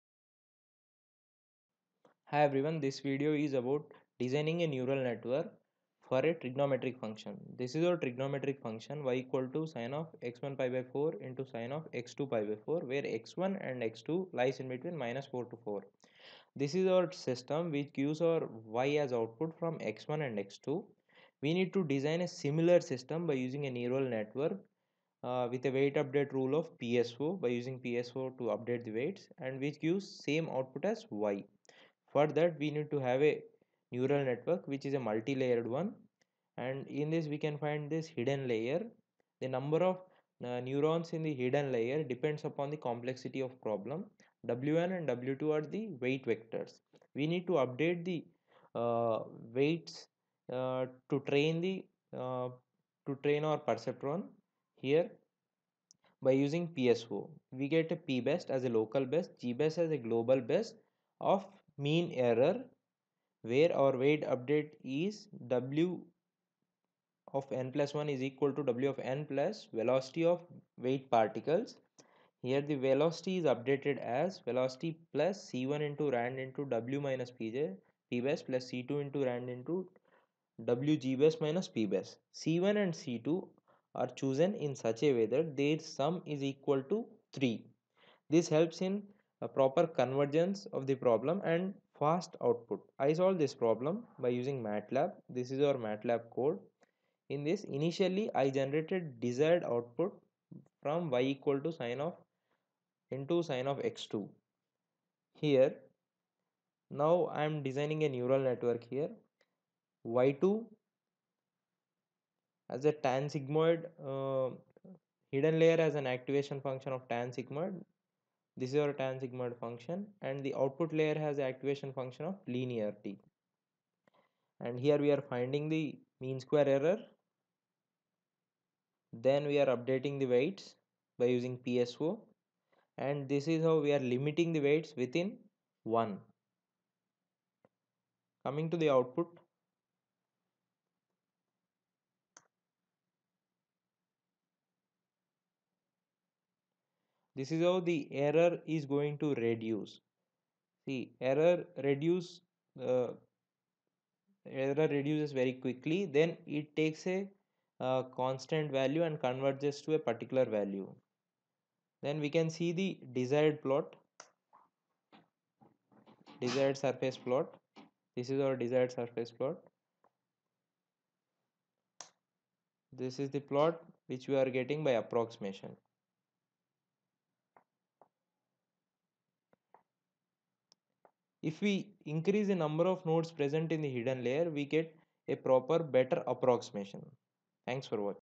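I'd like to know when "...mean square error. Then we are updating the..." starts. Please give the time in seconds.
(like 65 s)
126 s.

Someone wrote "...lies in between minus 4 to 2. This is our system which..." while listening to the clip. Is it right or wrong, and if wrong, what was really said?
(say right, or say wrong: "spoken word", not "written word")
wrong: "4", not "2".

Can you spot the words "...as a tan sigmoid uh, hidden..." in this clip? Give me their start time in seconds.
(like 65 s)
112 s.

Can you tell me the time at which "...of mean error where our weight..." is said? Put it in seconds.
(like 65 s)
61 s.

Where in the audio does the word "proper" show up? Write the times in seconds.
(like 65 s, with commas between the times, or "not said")
89 s, 185 s.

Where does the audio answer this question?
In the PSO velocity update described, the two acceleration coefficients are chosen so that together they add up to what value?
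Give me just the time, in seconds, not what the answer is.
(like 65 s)
87 s.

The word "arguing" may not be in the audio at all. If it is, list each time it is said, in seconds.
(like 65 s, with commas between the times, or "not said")
not said.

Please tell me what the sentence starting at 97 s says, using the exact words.
In this initially I generated desired output from y equal to sine of into sine of x2.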